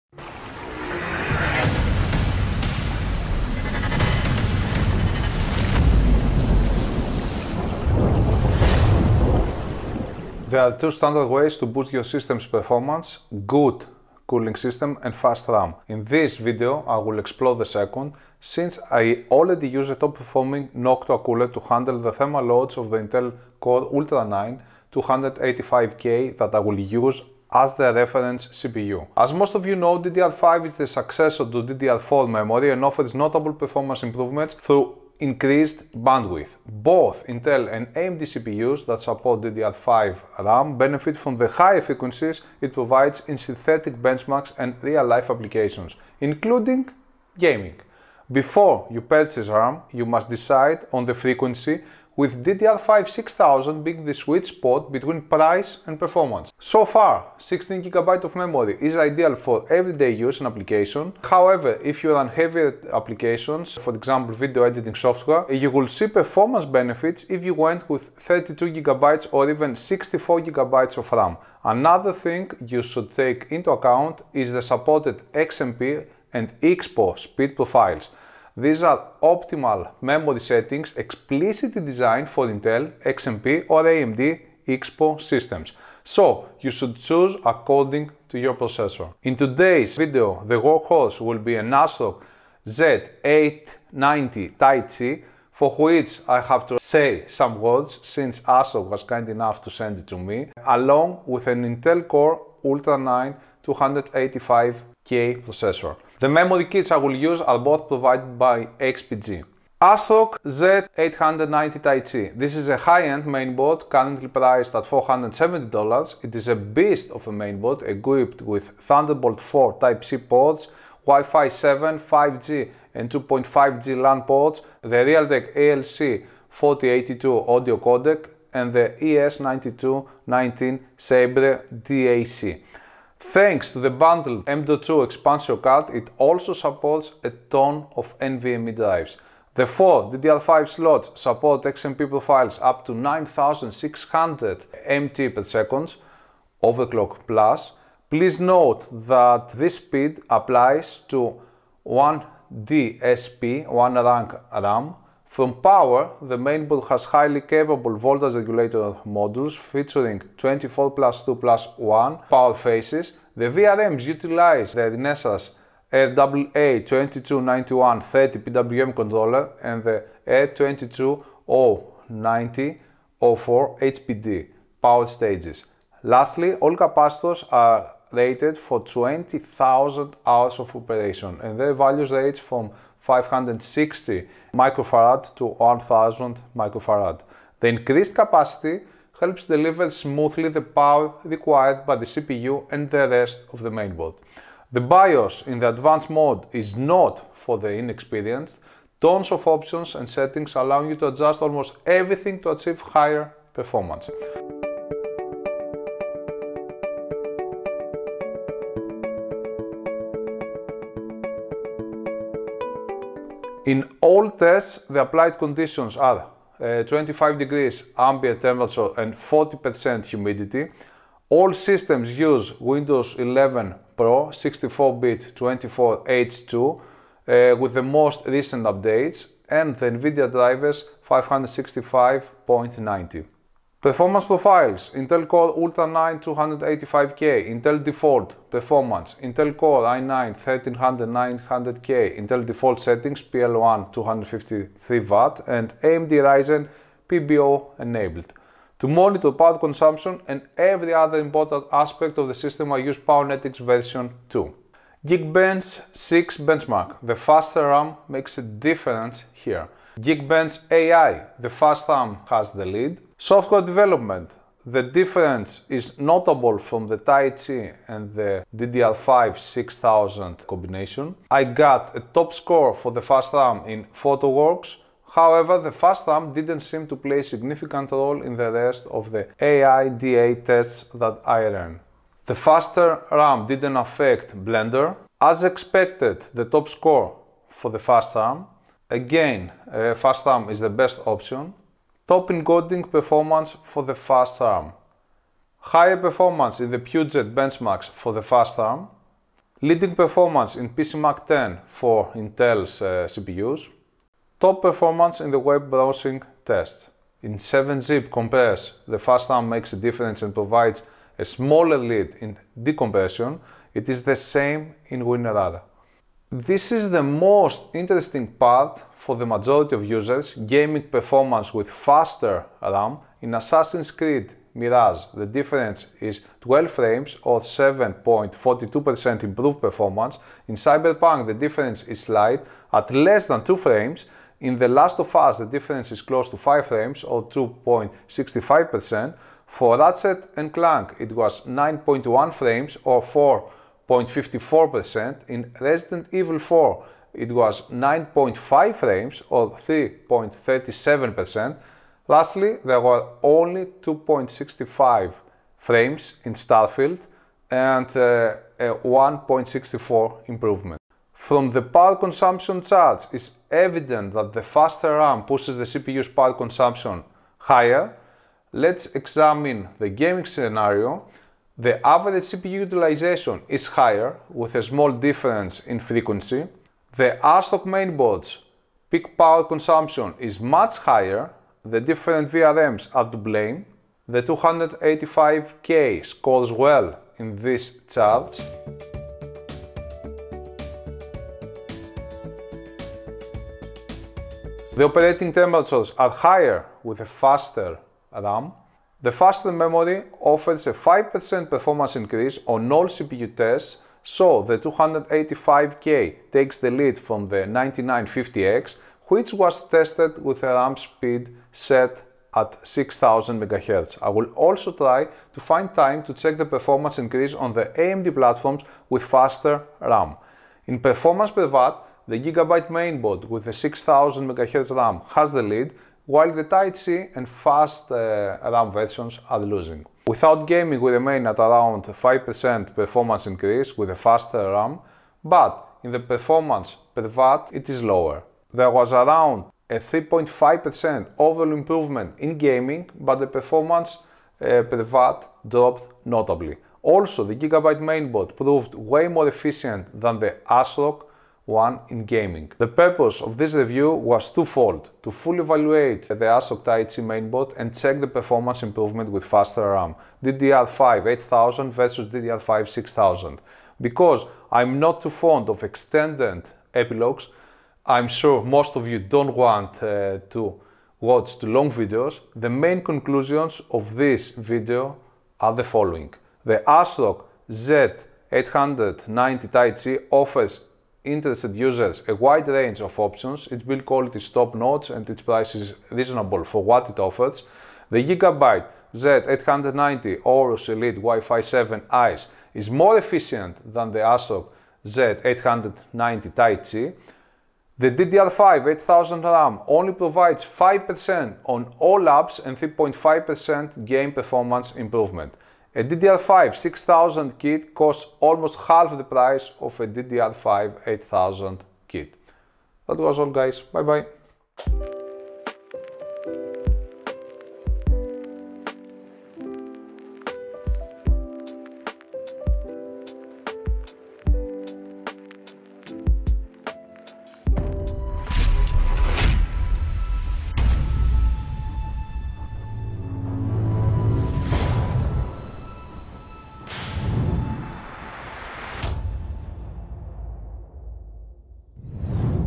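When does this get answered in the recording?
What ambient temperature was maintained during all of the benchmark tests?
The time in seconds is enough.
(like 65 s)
216 s.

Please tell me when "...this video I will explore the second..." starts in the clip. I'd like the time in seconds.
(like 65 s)
16 s.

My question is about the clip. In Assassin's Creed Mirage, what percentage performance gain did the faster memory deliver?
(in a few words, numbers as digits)
7.42%.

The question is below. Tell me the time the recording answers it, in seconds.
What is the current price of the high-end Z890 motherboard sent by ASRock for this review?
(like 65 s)
114 s.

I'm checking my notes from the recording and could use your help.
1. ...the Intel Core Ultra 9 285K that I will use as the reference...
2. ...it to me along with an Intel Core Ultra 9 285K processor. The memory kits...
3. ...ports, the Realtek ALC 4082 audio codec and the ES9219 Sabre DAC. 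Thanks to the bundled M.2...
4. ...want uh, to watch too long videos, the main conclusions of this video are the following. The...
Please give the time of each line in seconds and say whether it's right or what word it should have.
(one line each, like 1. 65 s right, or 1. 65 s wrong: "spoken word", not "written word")
1. 22 s right
2. 99 s right
3. 124 s right
4. 469 s right.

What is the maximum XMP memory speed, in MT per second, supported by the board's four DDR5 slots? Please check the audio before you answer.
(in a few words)
9600.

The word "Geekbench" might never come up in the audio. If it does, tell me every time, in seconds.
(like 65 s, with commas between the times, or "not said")
255 s, 259 s.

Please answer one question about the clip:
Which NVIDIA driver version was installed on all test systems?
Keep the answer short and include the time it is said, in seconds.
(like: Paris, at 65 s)
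565.90, at 231 s.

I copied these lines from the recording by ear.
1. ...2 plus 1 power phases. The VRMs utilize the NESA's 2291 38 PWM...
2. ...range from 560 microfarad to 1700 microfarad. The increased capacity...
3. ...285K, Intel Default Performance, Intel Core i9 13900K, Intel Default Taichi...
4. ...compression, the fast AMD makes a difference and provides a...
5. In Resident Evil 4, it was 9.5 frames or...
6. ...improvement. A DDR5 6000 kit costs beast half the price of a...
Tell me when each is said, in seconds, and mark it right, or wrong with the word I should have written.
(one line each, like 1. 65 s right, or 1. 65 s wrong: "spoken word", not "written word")
1. 161 s wrong: "30", not "38"
2. 182 s wrong: "1000", not "1700"
3. 236 s wrong: "Settings", not "Taichi"
4. 308 s wrong: "RAM", not "AMD"
5. 345 s right
6. 504 s wrong: "almost", not "beast".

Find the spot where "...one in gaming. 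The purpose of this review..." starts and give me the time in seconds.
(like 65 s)
451 s.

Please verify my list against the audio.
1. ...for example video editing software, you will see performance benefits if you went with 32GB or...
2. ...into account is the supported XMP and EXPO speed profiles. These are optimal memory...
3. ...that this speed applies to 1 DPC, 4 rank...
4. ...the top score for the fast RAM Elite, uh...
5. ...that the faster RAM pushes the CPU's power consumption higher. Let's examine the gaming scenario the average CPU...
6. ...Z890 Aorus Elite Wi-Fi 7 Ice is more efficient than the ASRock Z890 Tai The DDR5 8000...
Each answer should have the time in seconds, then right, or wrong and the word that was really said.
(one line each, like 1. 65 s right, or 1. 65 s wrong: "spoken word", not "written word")
1. 63 s right
2. 73 s right
3. 149 s wrong: "1", not "4"
4. 286 s wrong: "Again", not "Elite"
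5. 364 s right
6. 488 s right.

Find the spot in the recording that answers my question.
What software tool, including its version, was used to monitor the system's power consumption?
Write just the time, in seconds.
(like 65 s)
252 s.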